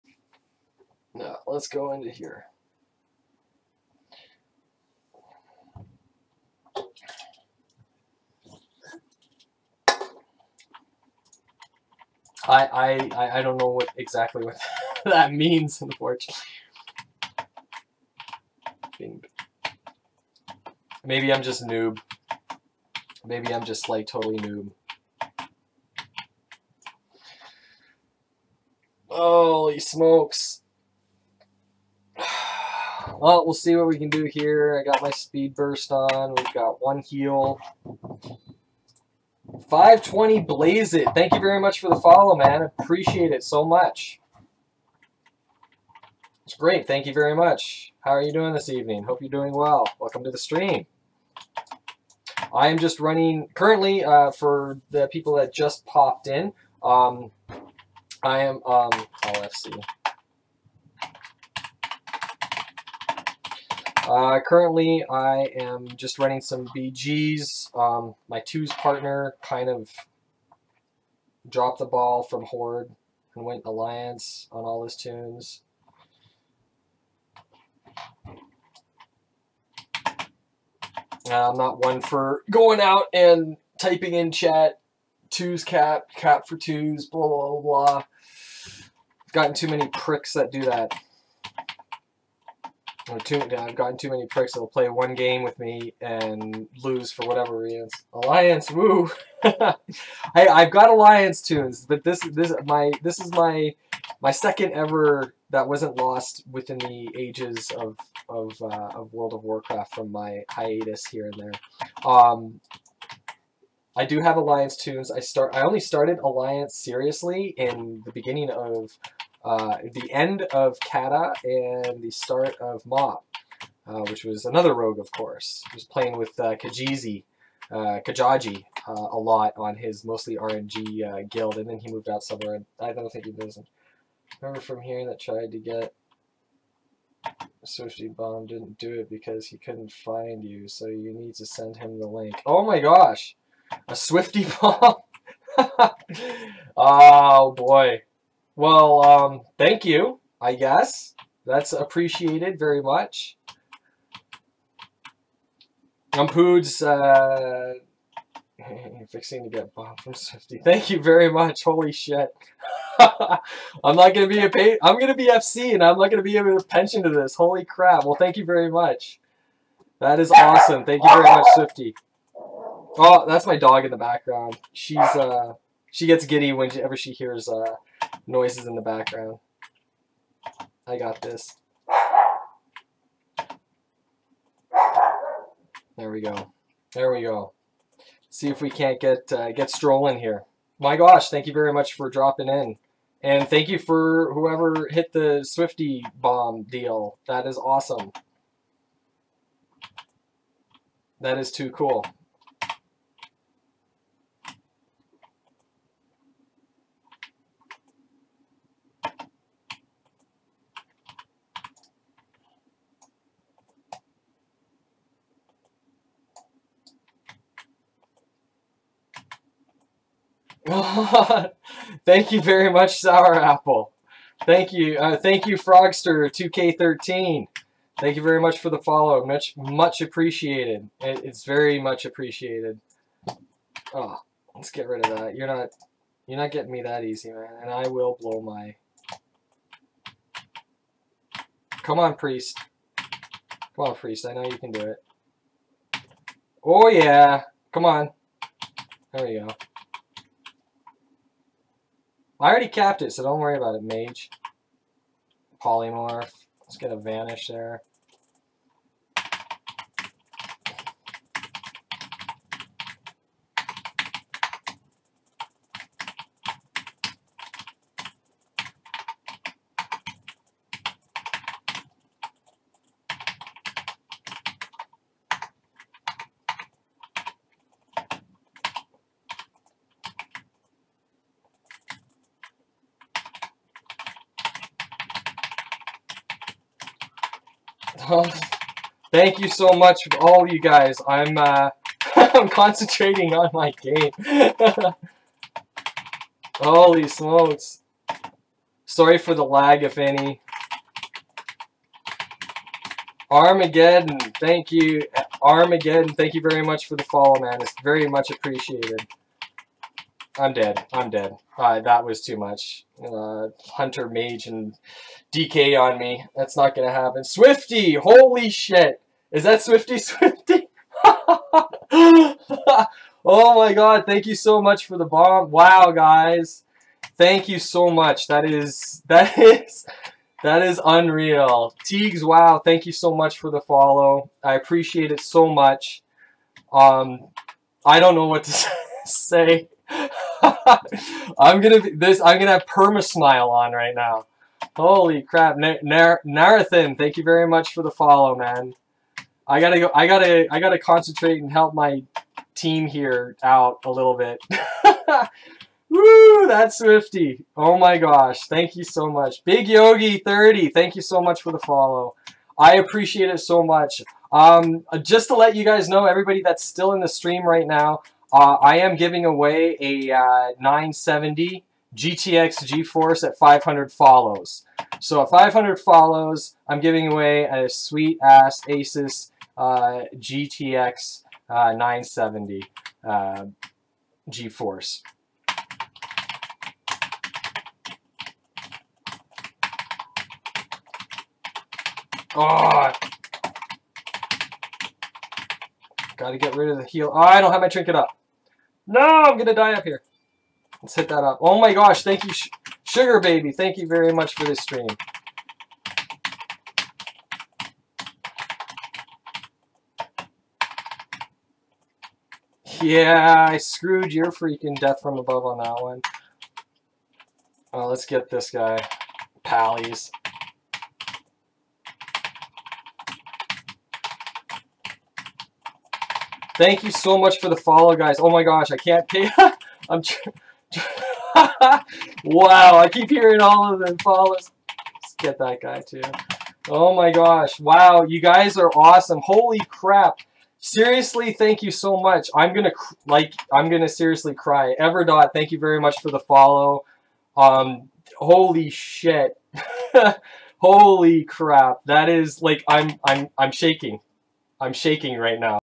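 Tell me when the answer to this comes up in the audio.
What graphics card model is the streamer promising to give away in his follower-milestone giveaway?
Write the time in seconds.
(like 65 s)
380 s.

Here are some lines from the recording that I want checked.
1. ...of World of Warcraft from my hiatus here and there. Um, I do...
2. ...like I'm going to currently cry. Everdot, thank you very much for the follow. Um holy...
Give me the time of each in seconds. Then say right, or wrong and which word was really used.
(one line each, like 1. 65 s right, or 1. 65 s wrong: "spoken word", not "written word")
1. 108 s right
2. 443 s wrong: "seriously", not "currently".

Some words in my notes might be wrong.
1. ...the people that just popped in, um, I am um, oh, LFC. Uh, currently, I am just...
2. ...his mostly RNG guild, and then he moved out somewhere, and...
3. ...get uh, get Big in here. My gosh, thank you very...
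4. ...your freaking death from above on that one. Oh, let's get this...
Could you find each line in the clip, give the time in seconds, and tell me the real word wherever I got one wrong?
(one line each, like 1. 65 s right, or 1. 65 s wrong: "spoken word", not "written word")
1. 54 s right
2. 129 s right
3. 189 s wrong: "Stroll", not "Big"
4. 414 s right.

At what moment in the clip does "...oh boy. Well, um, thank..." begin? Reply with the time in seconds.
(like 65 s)
146 s.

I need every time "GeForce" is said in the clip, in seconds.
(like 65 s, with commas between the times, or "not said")
372 s, 384 s.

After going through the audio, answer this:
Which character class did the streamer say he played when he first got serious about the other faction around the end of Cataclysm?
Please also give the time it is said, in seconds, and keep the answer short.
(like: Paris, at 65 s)
Rogue, at 124 s.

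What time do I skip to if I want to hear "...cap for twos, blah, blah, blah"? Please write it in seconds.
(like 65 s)
86 s.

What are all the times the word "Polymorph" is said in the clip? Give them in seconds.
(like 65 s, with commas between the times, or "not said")
255 s.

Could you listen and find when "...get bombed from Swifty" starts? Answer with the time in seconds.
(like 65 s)
159 s.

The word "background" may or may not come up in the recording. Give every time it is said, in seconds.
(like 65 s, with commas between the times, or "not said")
173 s, 178 s.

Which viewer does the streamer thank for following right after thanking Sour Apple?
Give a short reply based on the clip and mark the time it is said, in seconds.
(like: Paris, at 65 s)
Frogster2K13, at 225 s.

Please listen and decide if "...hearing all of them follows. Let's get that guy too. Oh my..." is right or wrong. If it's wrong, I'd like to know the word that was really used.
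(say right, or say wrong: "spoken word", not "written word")
right.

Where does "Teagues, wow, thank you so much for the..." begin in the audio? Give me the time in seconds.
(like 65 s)
331 s.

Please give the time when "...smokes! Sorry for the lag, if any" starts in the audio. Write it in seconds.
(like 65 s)
297 s.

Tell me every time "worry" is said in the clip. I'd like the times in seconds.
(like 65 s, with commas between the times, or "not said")
253 s.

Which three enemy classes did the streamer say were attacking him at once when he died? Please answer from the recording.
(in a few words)
Hunter, Mage, and DK.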